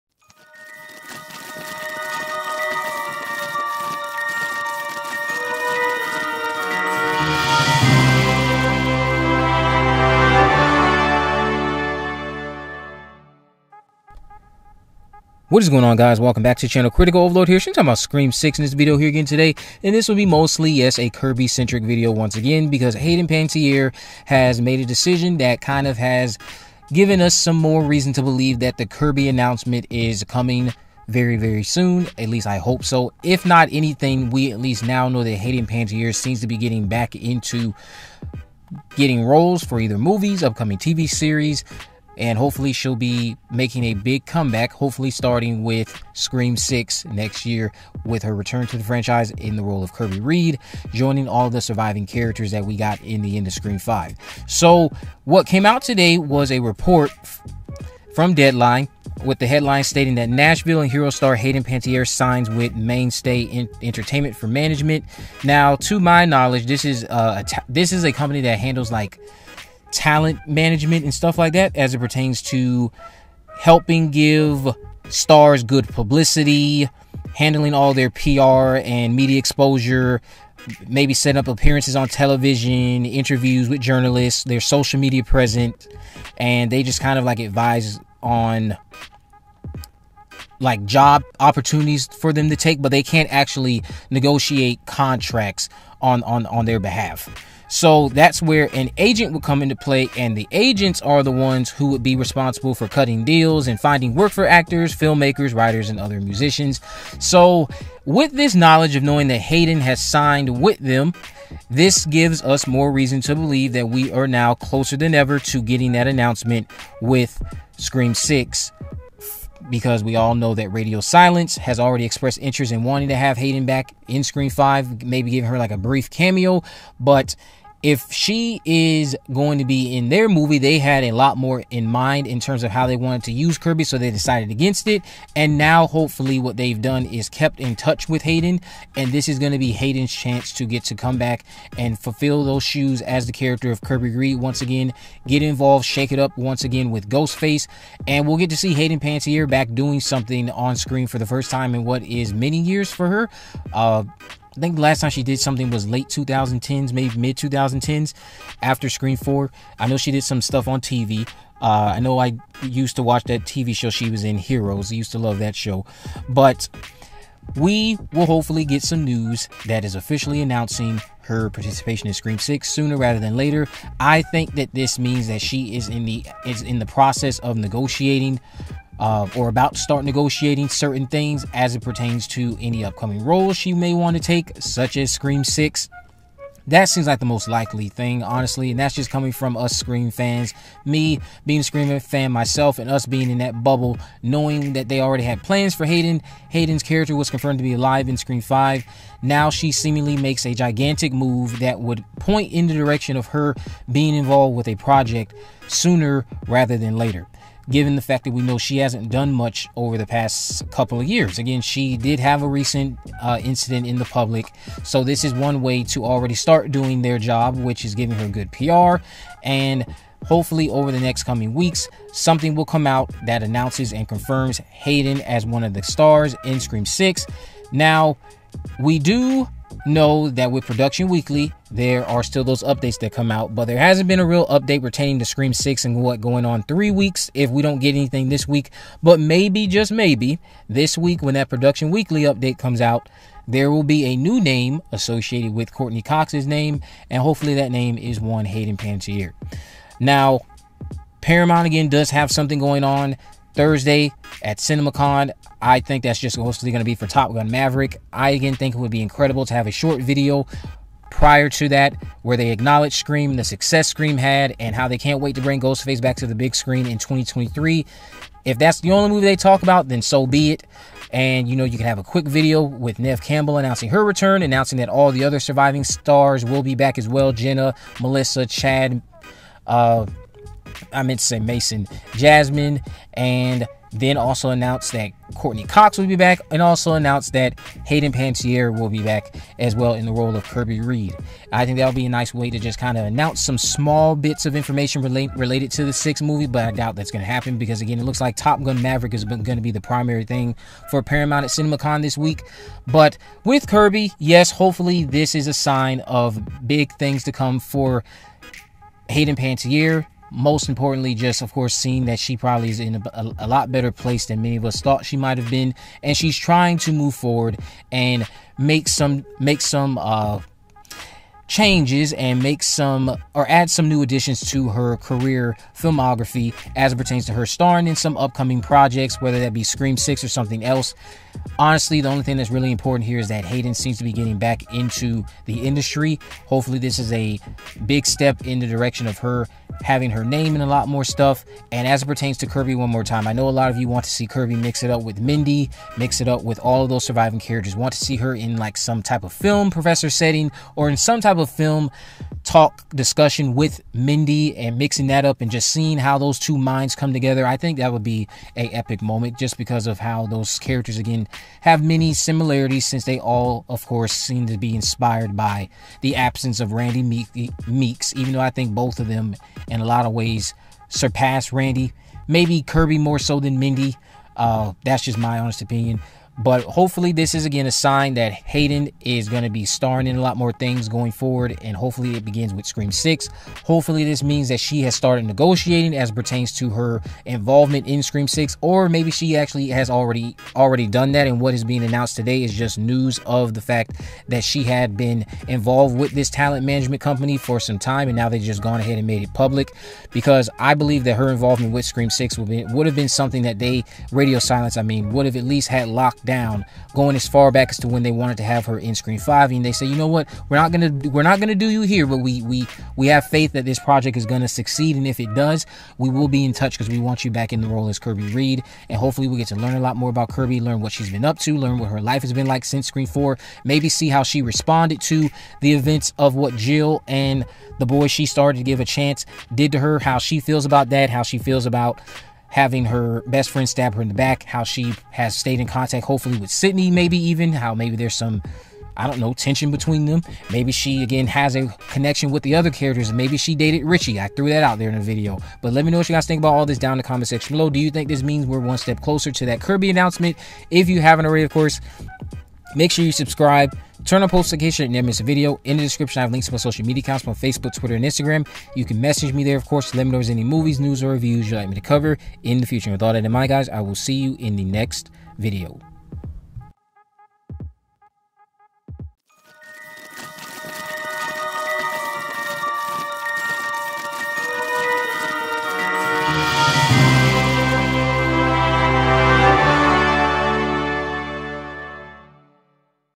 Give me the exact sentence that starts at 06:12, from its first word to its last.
Maybe Kirby more so than Mindy.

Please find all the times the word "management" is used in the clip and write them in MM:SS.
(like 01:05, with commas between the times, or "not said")
01:04, 01:10, 06:36.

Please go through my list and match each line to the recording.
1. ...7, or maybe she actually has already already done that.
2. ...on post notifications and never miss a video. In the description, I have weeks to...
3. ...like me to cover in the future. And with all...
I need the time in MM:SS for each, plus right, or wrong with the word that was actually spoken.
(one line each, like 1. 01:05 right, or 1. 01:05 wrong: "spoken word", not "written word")
1. 06:28 wrong: "6", not "7"
2. 07:34 wrong: "links", not "weeks"
3. 07:41 right.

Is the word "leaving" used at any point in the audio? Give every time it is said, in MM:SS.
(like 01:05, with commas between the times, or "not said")
not said.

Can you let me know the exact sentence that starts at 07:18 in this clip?
I don't know, tension between them.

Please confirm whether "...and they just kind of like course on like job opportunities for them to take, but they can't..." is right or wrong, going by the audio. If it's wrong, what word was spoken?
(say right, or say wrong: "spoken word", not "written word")
wrong: "advise", not "course".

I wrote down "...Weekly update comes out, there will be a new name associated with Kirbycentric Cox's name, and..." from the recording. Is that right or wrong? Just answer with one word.
wrong.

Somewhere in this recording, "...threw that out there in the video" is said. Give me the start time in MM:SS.
07:24.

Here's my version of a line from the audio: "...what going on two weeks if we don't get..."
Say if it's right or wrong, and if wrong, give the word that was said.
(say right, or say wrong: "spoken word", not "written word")
wrong: "three", not "two".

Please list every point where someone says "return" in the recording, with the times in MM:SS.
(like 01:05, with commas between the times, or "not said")
00:48, 04:34.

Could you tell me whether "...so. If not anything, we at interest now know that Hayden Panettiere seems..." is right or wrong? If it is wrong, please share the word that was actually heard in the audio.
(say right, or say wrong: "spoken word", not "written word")
wrong: "least", not "interest".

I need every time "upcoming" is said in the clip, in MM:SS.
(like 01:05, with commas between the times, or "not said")
00:40, 03:02, 05:28.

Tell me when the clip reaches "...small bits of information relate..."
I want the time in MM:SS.
04:53.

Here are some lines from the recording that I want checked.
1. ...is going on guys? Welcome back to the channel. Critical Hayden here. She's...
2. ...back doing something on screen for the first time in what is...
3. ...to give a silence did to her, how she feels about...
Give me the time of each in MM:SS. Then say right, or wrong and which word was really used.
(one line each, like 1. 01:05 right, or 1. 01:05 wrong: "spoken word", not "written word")
1. 00:15 wrong: "Overlord", not "Hayden"
2. 02:29 right
3. 07:08 wrong: "chance", not "silence".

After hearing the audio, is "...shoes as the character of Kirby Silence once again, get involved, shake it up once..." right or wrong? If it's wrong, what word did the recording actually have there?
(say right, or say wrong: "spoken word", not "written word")
wrong: "Reed", not "Silence".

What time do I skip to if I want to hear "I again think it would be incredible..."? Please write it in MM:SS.
04:18.